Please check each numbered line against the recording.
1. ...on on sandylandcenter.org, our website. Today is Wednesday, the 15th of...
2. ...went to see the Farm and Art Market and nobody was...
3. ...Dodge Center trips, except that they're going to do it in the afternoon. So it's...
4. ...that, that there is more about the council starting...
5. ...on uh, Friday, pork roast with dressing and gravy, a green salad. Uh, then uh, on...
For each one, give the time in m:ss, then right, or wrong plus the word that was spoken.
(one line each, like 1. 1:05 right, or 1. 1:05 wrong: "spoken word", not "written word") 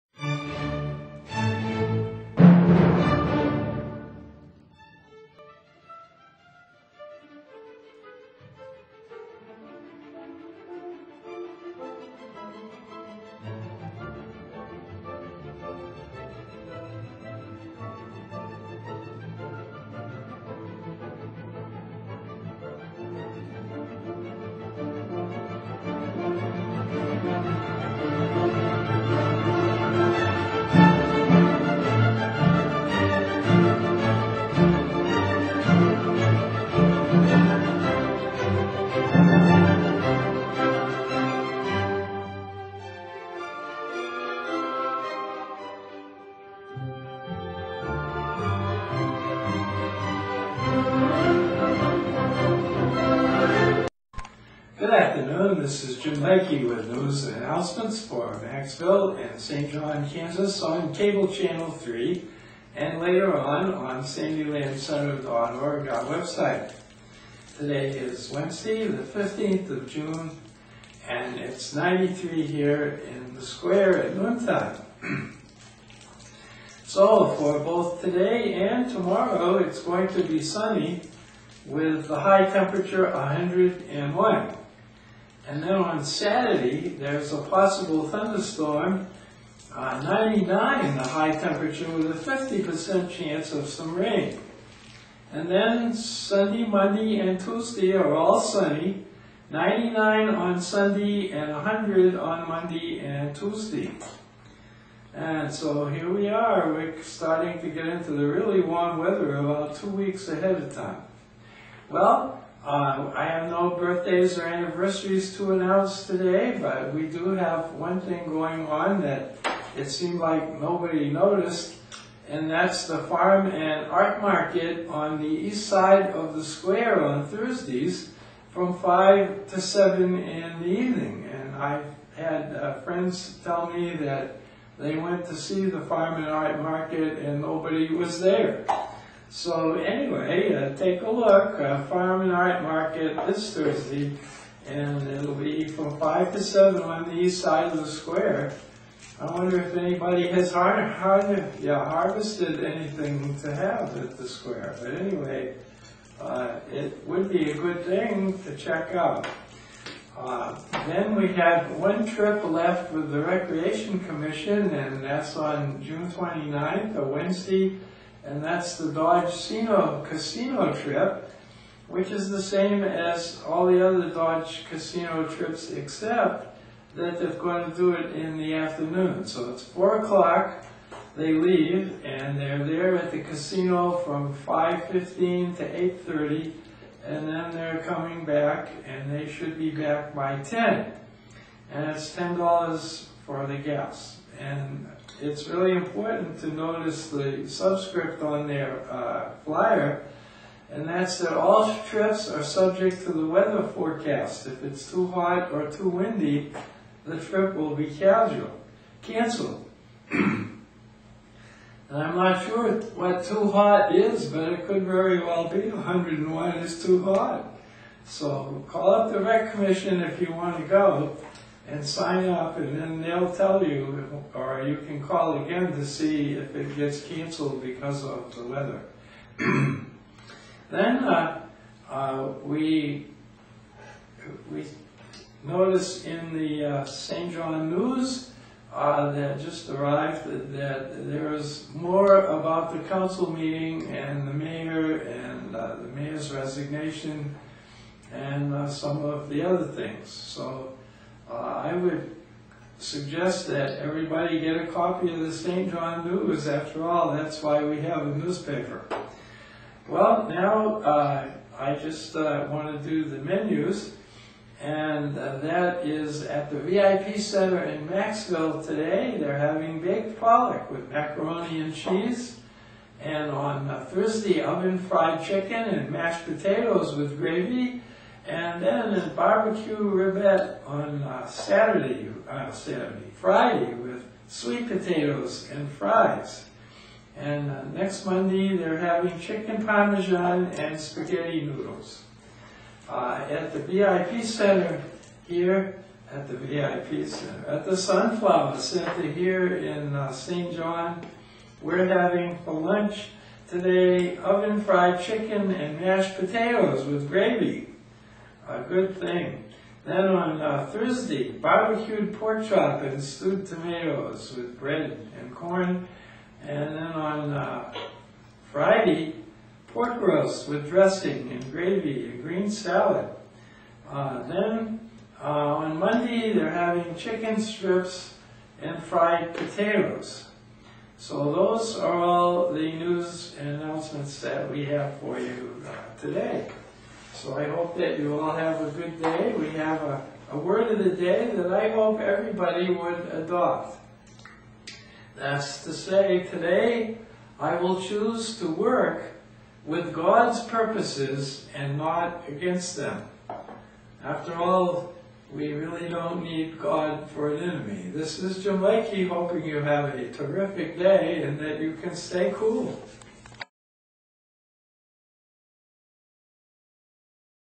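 1. 1:03 right
2. 2:14 right
3. 2:54 wrong: "Casino", not "Center"
4. 4:00 wrong: "meeting", not "starting"
5. 5:16 right.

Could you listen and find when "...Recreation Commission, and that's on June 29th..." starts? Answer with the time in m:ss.
2:43.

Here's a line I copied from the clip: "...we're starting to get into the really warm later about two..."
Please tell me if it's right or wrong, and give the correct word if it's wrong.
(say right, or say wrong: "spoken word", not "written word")
wrong: "weather", not "later".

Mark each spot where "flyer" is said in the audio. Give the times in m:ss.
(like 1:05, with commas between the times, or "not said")
3:19.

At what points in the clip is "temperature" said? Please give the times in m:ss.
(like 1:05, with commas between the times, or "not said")
1:22, 1:31.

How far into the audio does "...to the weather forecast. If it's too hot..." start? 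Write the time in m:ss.
3:23.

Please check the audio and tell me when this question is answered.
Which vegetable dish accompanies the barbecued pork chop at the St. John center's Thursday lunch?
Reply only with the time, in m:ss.
5:13.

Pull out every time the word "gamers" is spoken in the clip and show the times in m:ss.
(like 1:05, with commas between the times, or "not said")
not said.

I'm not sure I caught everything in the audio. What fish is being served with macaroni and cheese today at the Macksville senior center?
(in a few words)
Pollock.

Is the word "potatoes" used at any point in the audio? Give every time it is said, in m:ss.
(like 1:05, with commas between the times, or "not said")
4:36, 4:44, 5:06, 5:29.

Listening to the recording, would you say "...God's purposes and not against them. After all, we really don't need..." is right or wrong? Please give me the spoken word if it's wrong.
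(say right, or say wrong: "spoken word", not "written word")
right.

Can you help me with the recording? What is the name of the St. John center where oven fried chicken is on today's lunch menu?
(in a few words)
Sunflower Center.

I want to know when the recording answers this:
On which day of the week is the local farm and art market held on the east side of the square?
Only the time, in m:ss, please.
2:07.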